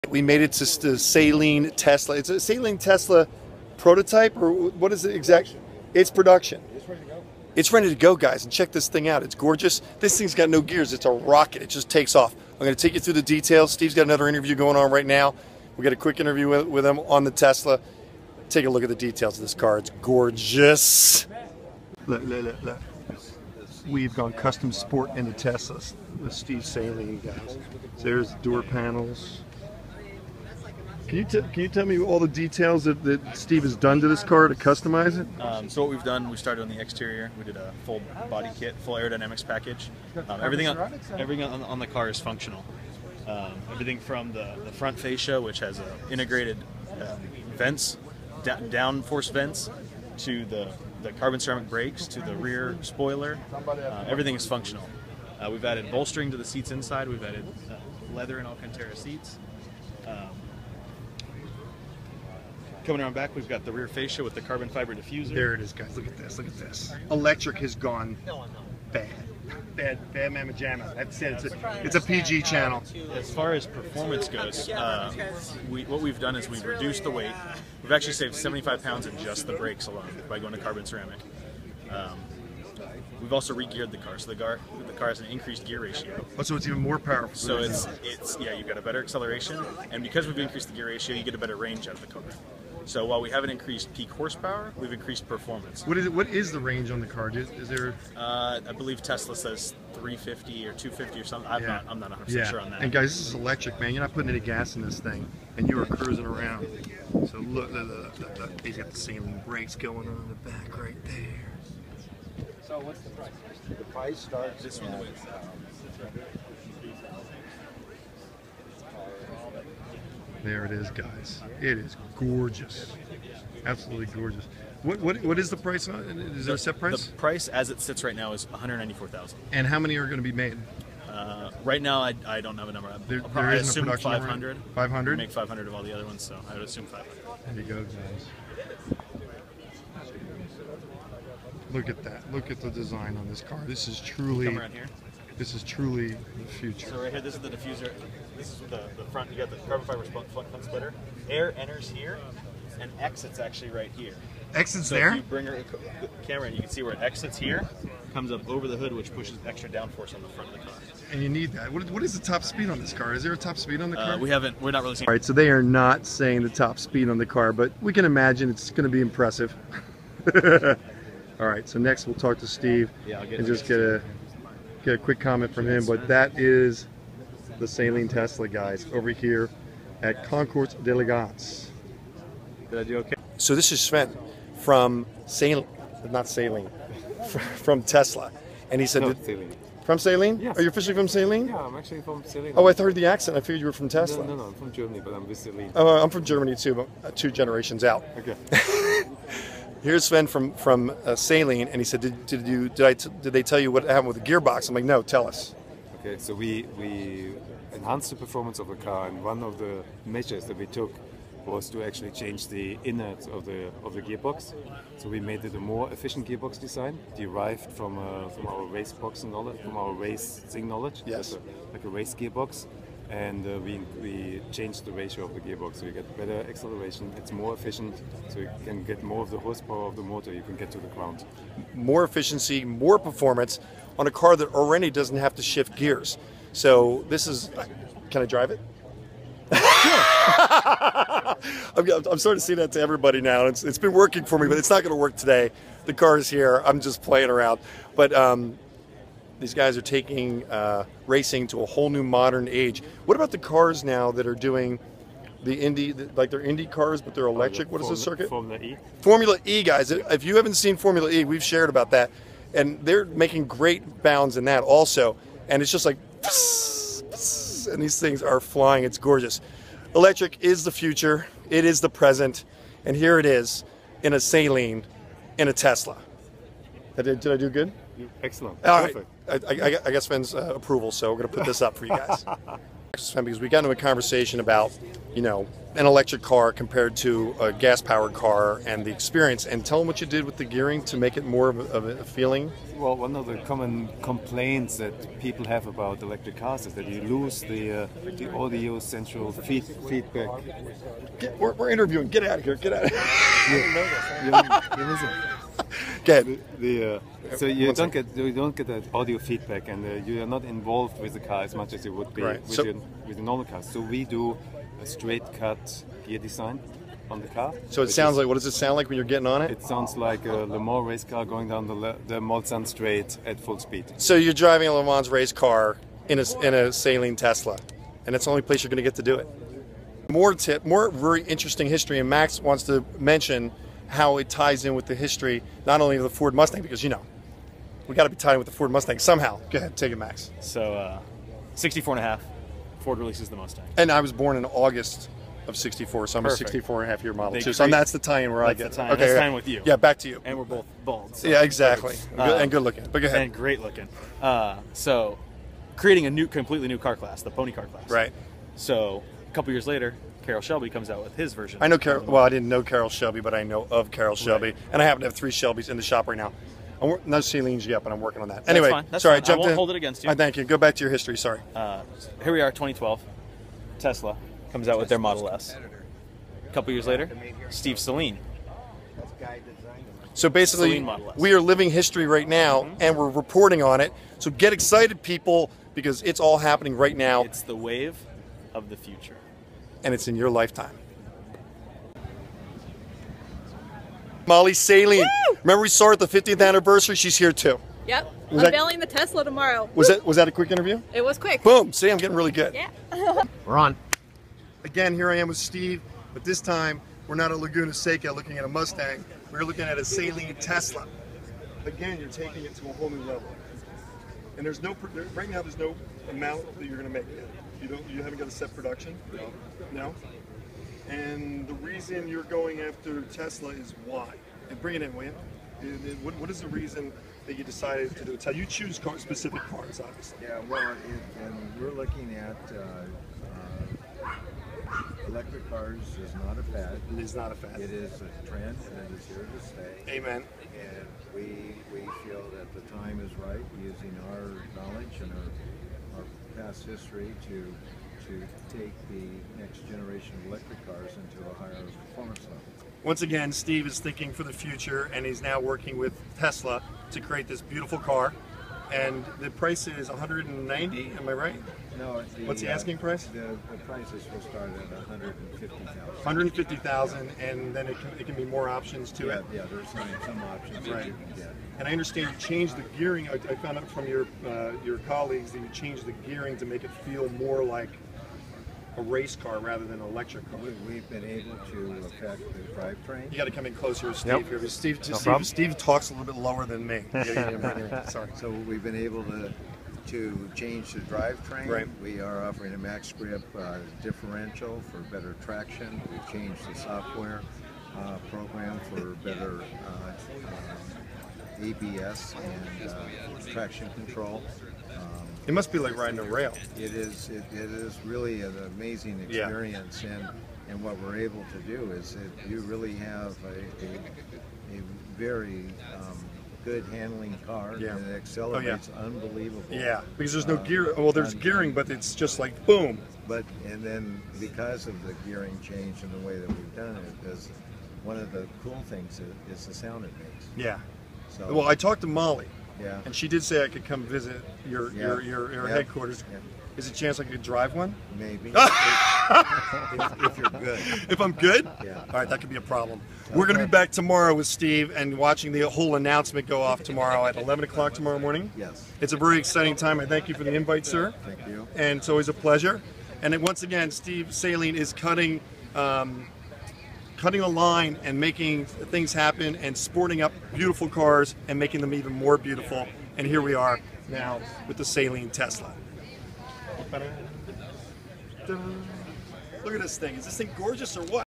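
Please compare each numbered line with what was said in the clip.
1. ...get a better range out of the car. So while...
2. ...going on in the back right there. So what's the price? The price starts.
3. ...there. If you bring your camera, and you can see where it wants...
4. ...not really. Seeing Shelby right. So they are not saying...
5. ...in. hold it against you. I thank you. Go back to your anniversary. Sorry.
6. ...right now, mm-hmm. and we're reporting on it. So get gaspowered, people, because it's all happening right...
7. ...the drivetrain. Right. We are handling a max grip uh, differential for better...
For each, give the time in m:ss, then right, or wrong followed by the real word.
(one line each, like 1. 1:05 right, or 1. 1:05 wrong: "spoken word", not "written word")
1. 1:31 right
2. 1:49 right
3. 2:34 wrong: "exits", not "wants"
4. 2:44 wrong: "All", not "Shelby"
5. 6:09 wrong: "history", not "anniversary"
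6. 6:22 wrong: "excited", not "gaspowered"
7. 8:10 wrong: "offering", not "handling".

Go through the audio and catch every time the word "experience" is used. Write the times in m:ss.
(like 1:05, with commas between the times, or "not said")
4:48, 8:29.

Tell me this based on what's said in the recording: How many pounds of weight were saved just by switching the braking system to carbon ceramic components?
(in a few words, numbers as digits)
75.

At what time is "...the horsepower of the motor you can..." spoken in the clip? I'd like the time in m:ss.
3:49.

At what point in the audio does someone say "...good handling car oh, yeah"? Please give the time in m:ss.
8:36.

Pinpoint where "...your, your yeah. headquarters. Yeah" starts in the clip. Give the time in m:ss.
8:55.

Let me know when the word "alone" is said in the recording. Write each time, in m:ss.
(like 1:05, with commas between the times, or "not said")
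1:19.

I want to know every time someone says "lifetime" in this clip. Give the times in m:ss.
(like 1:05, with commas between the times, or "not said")
6:30.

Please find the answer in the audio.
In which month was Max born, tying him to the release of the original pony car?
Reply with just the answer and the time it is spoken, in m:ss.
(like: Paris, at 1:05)
August, at 5:44.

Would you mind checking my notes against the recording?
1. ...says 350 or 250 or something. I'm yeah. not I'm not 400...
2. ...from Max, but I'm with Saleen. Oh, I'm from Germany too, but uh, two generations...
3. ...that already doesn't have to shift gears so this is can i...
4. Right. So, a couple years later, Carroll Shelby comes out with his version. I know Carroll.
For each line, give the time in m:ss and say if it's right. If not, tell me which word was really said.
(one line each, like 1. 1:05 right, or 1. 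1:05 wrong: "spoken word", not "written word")
1. 1:39 wrong: "100", not "400"
2. 3:14 wrong: "Germany", not "Max"
3. 3:54 right
4. 5:57 right.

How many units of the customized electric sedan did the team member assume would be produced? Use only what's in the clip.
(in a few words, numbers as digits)
500.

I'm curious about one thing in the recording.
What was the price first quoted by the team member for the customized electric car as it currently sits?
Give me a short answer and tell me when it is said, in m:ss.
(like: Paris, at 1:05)
194000, at 2:08.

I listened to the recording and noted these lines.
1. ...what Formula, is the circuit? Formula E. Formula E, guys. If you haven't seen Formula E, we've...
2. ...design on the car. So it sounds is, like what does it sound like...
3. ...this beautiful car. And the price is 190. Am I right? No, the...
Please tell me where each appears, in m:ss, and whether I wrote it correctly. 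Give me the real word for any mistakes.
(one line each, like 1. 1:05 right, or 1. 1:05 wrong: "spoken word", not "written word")
1. 4:17 right
2. 5:16 right
3. 7:37 right.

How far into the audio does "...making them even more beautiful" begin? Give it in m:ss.
9:21.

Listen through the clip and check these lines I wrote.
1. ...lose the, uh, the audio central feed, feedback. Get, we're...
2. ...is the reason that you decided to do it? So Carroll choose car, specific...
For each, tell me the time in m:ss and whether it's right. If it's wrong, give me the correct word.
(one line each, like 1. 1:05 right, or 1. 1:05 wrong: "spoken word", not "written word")
1. 4:57 right
2. 7:06 wrong: "You", not "Carroll".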